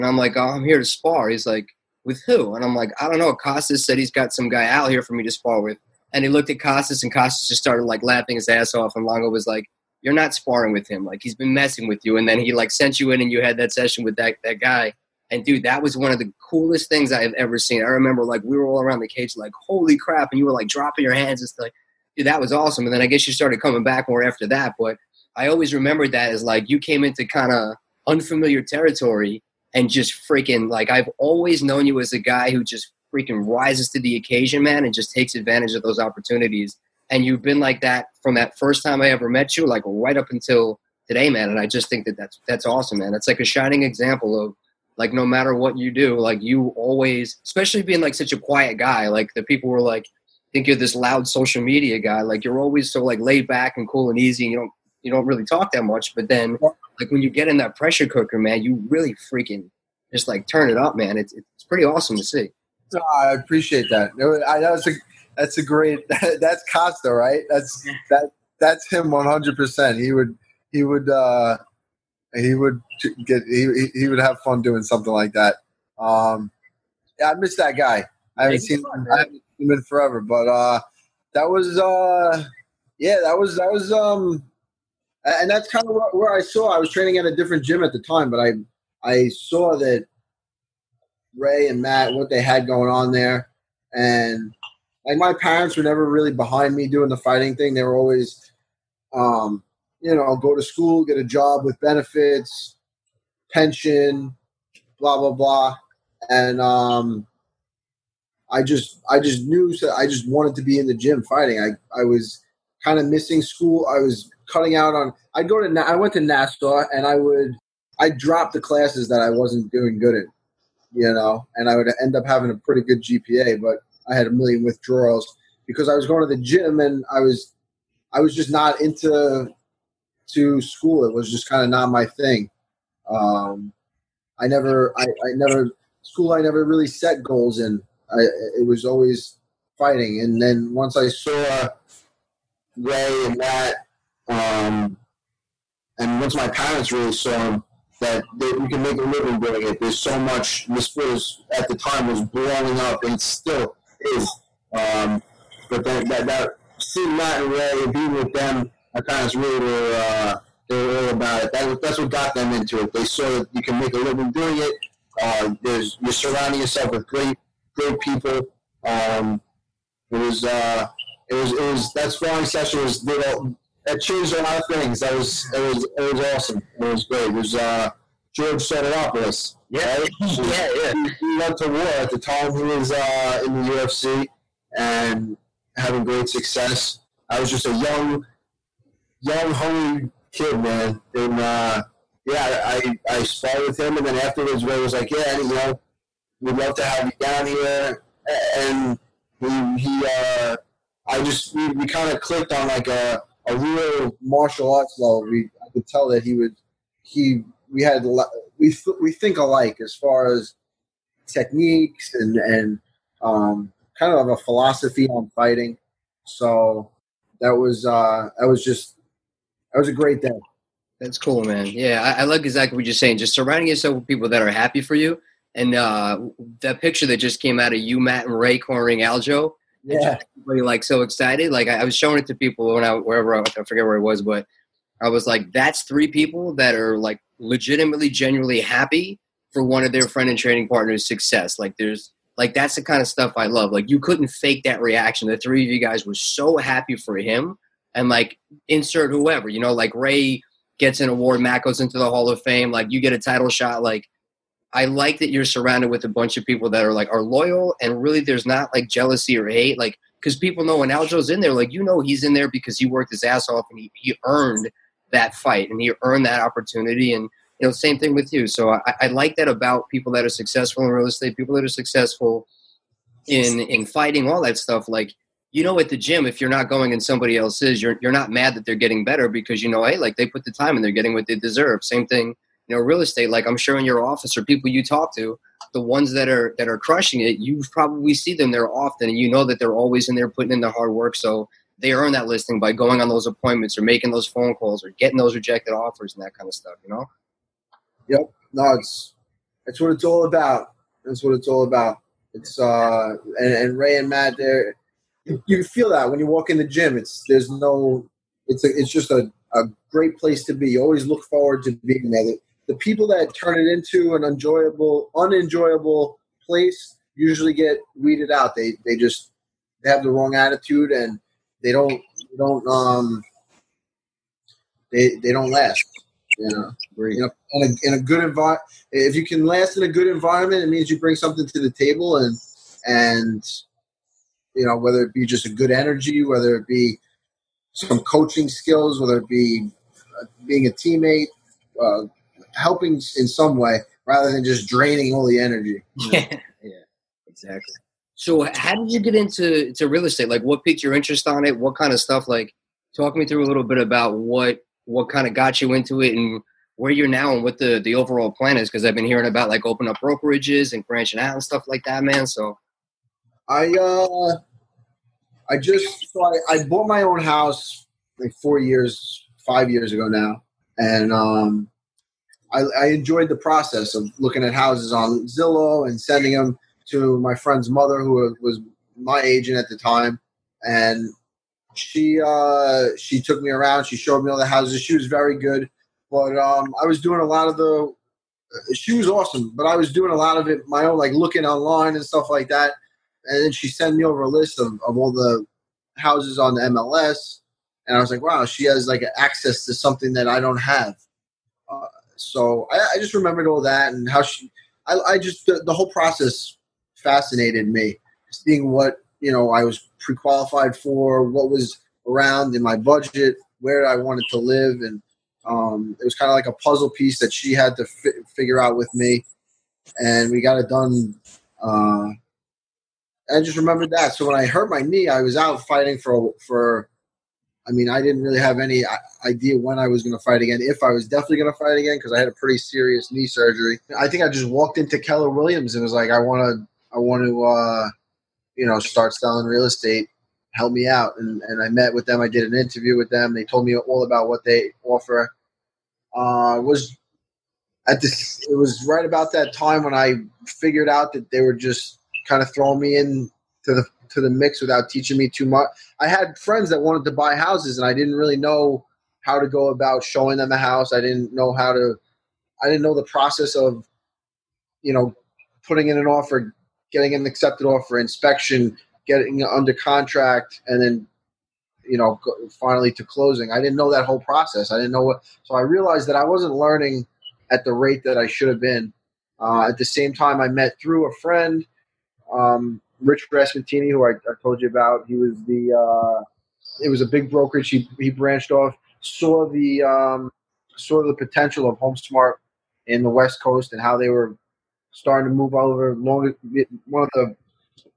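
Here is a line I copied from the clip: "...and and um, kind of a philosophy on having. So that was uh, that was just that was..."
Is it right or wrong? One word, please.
wrong.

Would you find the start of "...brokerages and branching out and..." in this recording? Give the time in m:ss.
6:00.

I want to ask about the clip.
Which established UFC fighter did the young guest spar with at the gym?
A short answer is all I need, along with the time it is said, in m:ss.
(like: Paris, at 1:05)
George Sotiropoulos, at 2:58.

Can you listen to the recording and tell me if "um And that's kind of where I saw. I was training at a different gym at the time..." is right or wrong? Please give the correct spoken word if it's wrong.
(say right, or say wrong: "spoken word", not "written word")
right.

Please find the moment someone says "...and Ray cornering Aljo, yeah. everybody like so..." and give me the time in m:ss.
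3:48.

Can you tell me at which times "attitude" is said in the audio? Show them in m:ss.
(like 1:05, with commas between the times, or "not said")
5:20.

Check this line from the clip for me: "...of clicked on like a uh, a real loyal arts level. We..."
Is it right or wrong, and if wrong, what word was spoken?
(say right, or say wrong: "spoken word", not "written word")
wrong: "martial", not "loyal".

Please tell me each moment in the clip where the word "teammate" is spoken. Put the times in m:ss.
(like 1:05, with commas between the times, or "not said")
5:40.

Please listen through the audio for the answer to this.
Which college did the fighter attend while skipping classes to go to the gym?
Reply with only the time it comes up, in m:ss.
1:56.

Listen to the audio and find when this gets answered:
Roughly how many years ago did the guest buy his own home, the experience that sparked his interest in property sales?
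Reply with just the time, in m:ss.
6:09.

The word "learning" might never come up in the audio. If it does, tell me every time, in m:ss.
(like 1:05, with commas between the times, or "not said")
7:56.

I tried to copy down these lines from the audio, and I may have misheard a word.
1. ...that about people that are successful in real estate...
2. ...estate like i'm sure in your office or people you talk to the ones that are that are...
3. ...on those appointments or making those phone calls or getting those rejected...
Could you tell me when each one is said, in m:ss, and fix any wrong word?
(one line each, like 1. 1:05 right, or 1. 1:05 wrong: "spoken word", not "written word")
1. 4:29 right
2. 4:43 right
3. 4:53 right.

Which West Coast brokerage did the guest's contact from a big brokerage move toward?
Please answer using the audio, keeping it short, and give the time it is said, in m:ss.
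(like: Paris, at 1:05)
HomeSmart, at 8:11.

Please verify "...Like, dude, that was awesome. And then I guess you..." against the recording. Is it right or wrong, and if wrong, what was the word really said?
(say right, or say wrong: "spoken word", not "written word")
right.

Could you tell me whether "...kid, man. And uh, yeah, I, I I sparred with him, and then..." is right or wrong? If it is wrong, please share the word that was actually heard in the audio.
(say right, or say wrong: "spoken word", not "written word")
right.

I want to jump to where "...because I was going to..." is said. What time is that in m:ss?
2:05.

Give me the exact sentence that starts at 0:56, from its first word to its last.
But then like when you get in that pressure cooker, man, you really freaking just like turn it up, man.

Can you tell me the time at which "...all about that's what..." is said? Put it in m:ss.
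5:00.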